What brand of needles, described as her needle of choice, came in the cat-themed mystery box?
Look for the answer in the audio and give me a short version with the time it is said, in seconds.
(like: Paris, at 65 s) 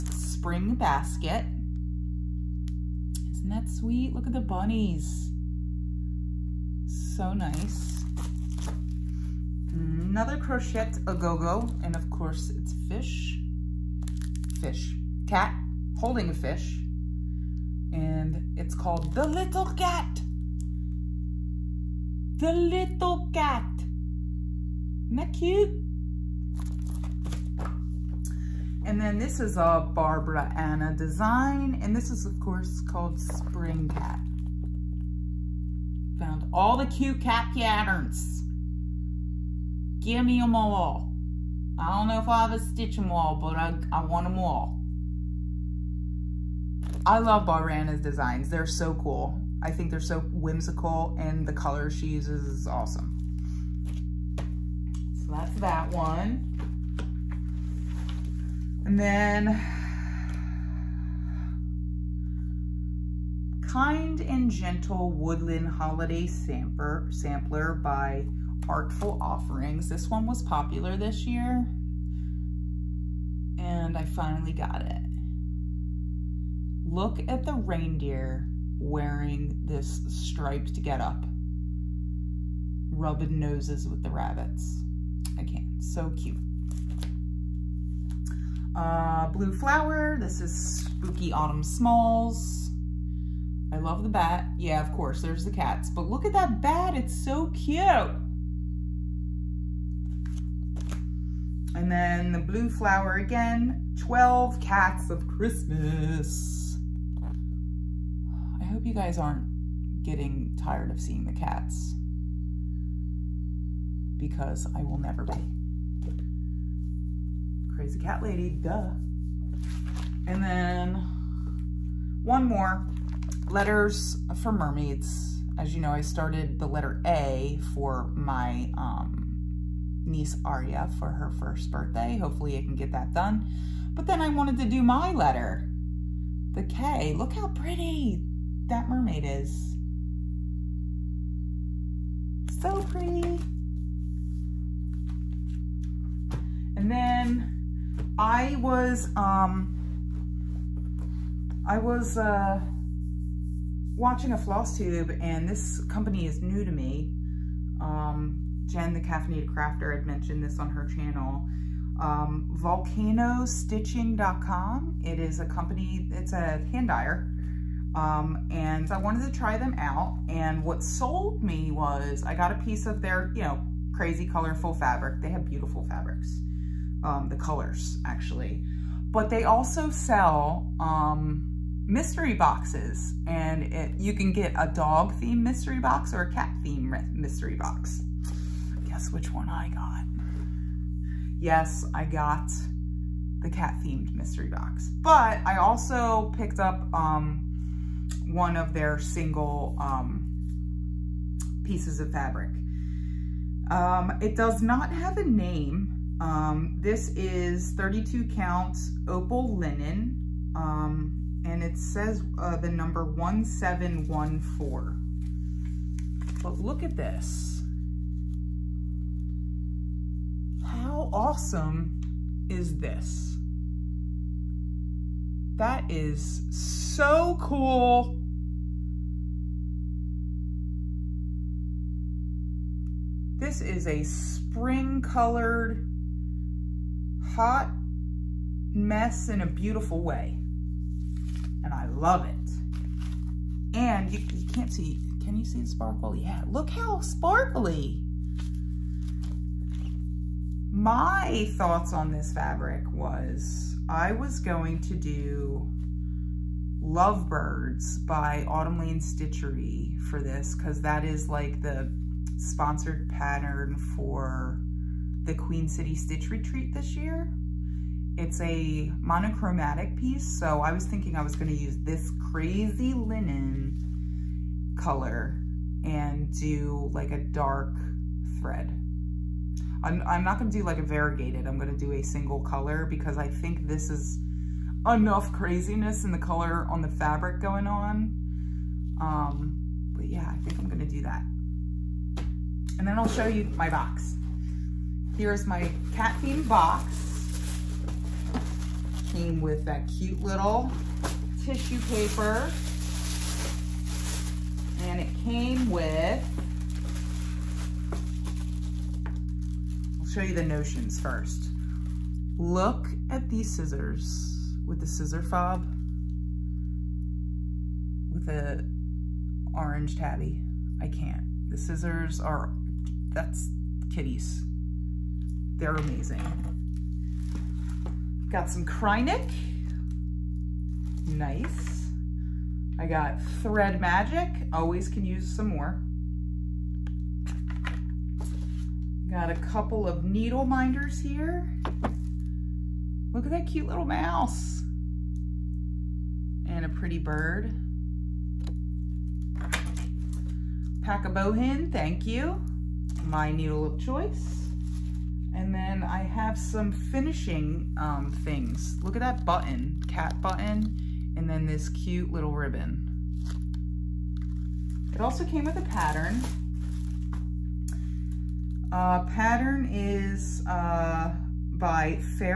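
Bohin, at 351 s.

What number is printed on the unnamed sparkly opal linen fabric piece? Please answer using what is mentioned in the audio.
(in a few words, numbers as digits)
1714.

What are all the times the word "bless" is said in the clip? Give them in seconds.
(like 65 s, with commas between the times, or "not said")
not said.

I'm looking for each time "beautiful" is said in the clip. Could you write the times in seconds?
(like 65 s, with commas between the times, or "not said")
175 s, 239 s.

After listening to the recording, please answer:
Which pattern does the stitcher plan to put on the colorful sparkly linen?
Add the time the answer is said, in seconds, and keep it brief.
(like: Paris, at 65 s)
Lovebirds, at 256 s.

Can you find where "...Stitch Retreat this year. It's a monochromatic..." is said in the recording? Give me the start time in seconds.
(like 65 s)
265 s.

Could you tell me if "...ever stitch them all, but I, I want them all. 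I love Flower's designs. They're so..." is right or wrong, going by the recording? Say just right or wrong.
wrong.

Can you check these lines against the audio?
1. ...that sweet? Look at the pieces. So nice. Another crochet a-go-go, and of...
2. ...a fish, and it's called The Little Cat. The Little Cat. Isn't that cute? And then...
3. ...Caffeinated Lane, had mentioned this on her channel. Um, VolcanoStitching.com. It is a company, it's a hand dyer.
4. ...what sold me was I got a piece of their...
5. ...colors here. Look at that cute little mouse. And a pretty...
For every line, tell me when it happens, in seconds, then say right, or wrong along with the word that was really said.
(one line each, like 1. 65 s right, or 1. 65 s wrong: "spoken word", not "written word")
1. 3 s wrong: "bunnies", not "pieces"
2. 16 s right
3. 159 s wrong: "Crafter", not "Lane"
4. 170 s right
5. 340 s wrong: "minders", not "colors".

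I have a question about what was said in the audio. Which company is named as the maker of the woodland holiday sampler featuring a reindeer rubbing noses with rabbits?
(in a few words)
Artful Offerings.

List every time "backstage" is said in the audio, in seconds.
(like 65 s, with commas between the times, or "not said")
not said.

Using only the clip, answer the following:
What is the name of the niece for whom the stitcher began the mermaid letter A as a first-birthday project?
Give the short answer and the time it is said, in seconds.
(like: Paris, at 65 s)
Aria, at 130 s.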